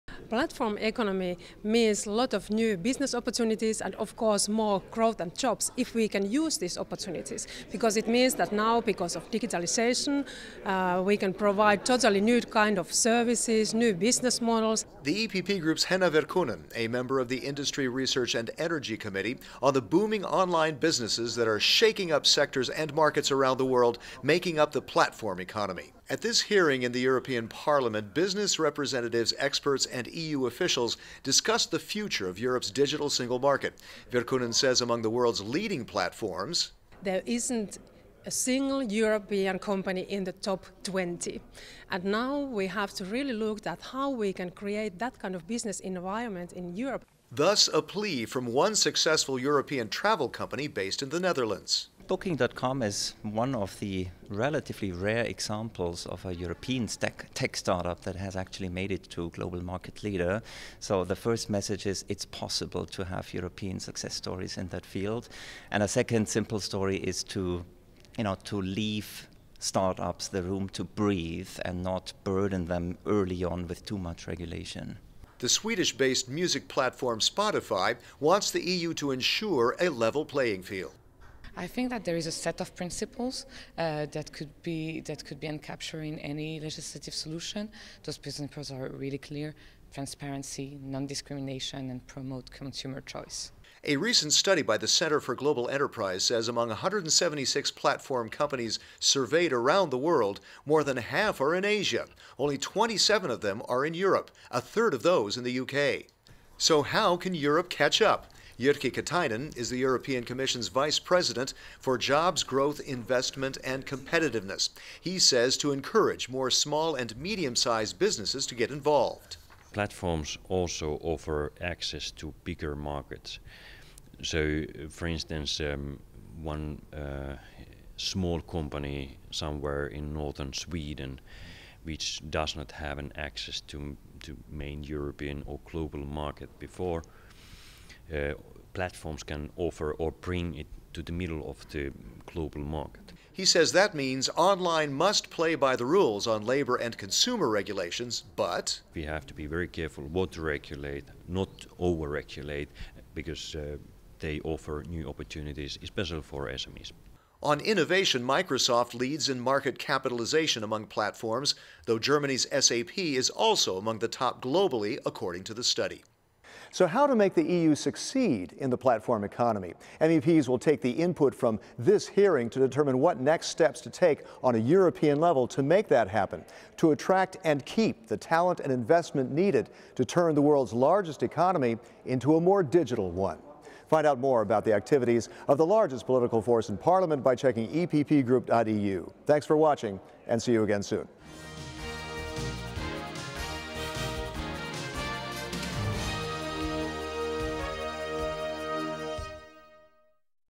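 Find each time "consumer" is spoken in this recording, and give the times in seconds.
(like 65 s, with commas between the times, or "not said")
92 s, 146 s.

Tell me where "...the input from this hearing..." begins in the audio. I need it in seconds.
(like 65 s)
170 s.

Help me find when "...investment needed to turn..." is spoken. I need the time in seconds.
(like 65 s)
178 s.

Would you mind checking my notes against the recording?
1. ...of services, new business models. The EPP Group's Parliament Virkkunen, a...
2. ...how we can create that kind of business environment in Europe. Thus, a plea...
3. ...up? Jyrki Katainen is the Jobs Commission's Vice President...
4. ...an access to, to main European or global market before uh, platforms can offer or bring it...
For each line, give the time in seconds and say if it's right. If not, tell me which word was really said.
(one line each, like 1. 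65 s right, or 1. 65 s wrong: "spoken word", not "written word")
1. 12 s wrong: "Henna", not "Parliament"
2. 43 s right
3. 108 s wrong: "European", not "Jobs"
4. 132 s right.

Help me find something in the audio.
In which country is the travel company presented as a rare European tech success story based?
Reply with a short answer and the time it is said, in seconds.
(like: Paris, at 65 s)
the Netherlands, at 51 s.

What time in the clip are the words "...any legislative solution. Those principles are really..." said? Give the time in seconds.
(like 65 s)
86 s.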